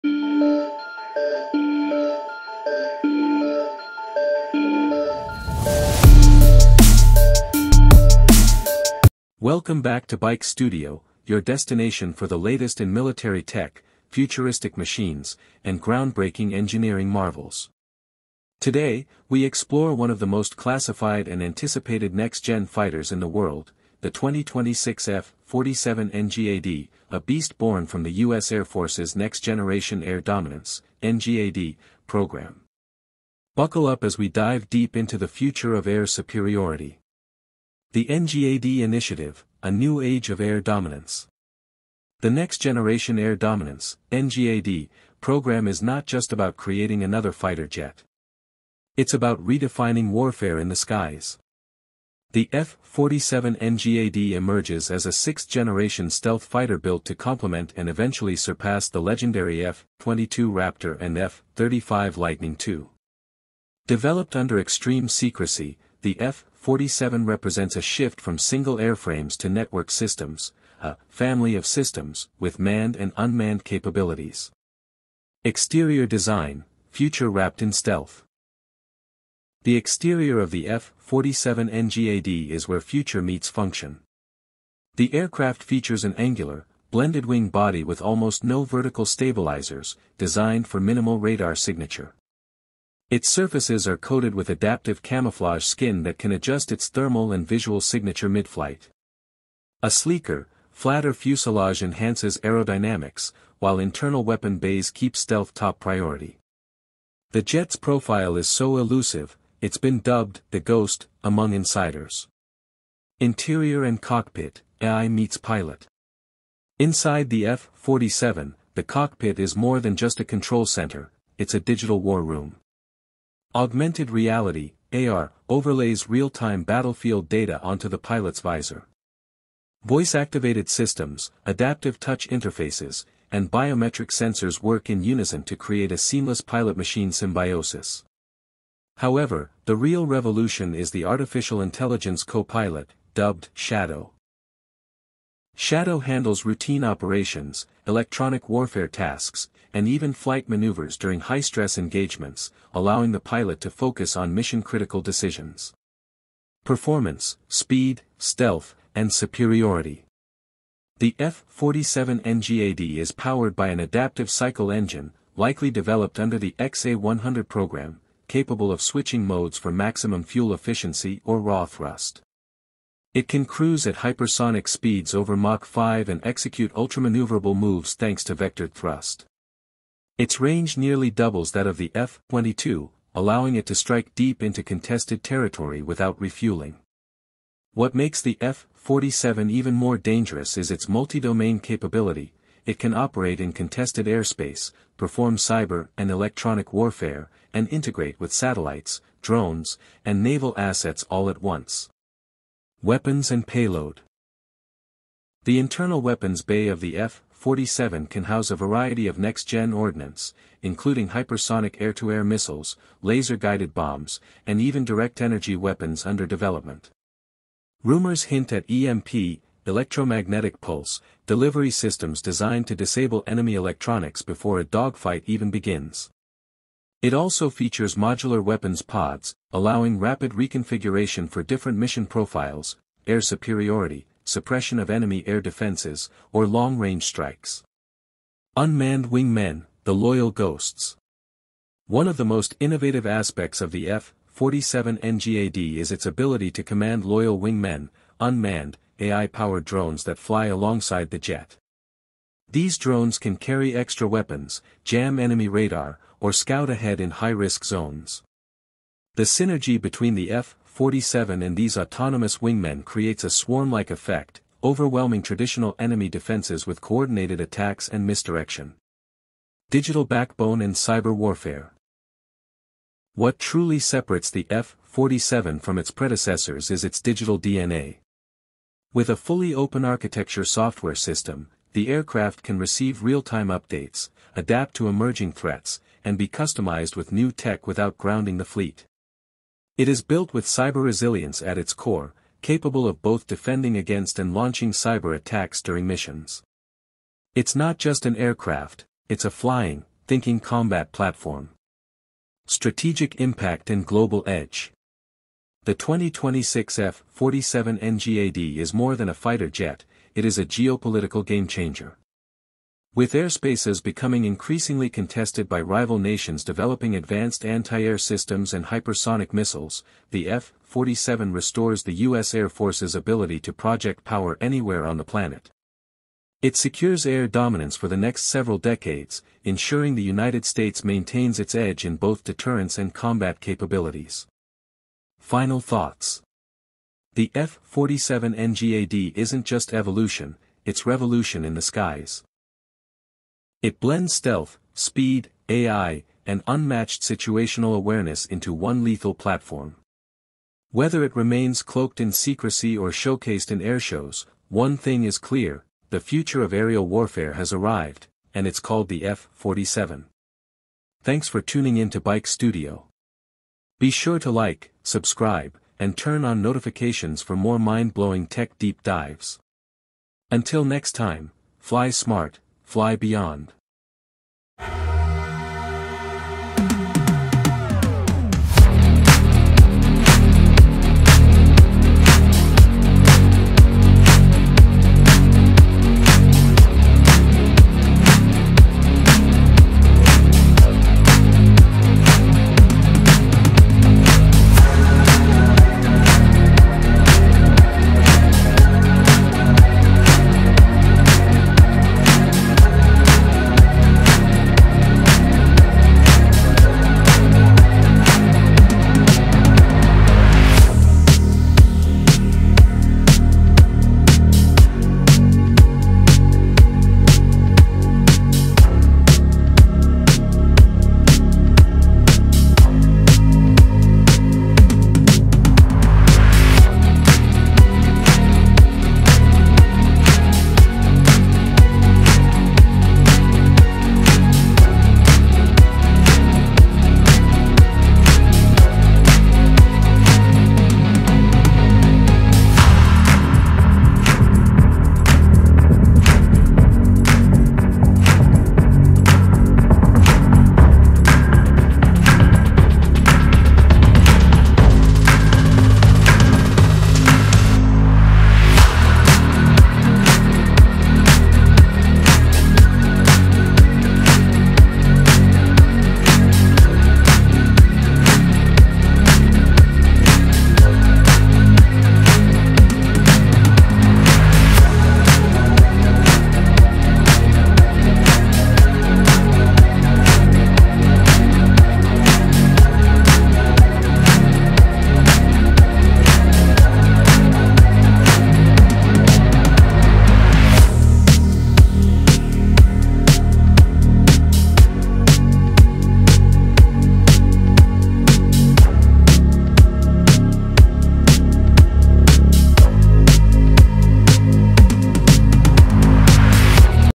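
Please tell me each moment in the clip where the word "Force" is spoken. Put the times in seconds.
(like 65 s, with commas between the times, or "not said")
28 s, 322 s.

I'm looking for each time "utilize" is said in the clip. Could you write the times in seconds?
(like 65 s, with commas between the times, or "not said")
not said.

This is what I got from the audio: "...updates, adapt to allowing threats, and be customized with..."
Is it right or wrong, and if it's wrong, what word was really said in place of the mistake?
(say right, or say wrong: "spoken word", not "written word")
wrong: "emerging", not "allowing".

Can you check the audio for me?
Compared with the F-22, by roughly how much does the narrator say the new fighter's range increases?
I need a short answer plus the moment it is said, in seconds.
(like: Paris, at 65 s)
nearly doubles, at 180 s.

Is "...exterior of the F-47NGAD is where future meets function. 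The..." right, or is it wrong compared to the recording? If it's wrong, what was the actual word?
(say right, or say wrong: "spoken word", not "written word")
right.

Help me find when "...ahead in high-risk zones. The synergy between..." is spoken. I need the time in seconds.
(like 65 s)
256 s.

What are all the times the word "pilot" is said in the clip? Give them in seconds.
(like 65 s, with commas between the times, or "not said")
115 s, 127 s, 136 s, 142 s, 153 s.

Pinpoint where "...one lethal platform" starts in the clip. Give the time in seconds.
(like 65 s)
348 s.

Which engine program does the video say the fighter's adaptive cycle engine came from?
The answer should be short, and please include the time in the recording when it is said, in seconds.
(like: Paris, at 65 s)
XA-100, at 166 s.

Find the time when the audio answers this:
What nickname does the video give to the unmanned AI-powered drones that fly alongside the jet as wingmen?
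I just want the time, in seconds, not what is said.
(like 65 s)
239 s.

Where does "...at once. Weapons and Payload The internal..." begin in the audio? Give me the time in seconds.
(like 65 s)
201 s.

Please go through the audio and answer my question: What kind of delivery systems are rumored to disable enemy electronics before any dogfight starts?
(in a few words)
EMP.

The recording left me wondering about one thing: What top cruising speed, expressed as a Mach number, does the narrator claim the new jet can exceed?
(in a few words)
Mach 5.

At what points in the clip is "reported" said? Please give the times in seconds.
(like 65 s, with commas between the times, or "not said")
not said.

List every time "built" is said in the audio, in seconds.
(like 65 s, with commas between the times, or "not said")
56 s, 290 s.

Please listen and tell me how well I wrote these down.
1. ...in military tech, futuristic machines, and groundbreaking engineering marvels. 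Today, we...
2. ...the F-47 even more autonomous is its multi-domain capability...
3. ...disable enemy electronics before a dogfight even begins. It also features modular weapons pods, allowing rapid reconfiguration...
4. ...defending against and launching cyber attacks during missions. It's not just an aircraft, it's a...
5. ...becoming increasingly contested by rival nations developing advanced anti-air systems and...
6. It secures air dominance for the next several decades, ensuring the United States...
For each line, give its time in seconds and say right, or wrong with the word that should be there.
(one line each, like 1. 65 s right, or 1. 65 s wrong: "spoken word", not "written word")
1. 12 s right
2. 188 s wrong: "dangerous", not "autonomous"
3. 222 s right
4. 293 s right
5. 313 s right
6. 326 s right.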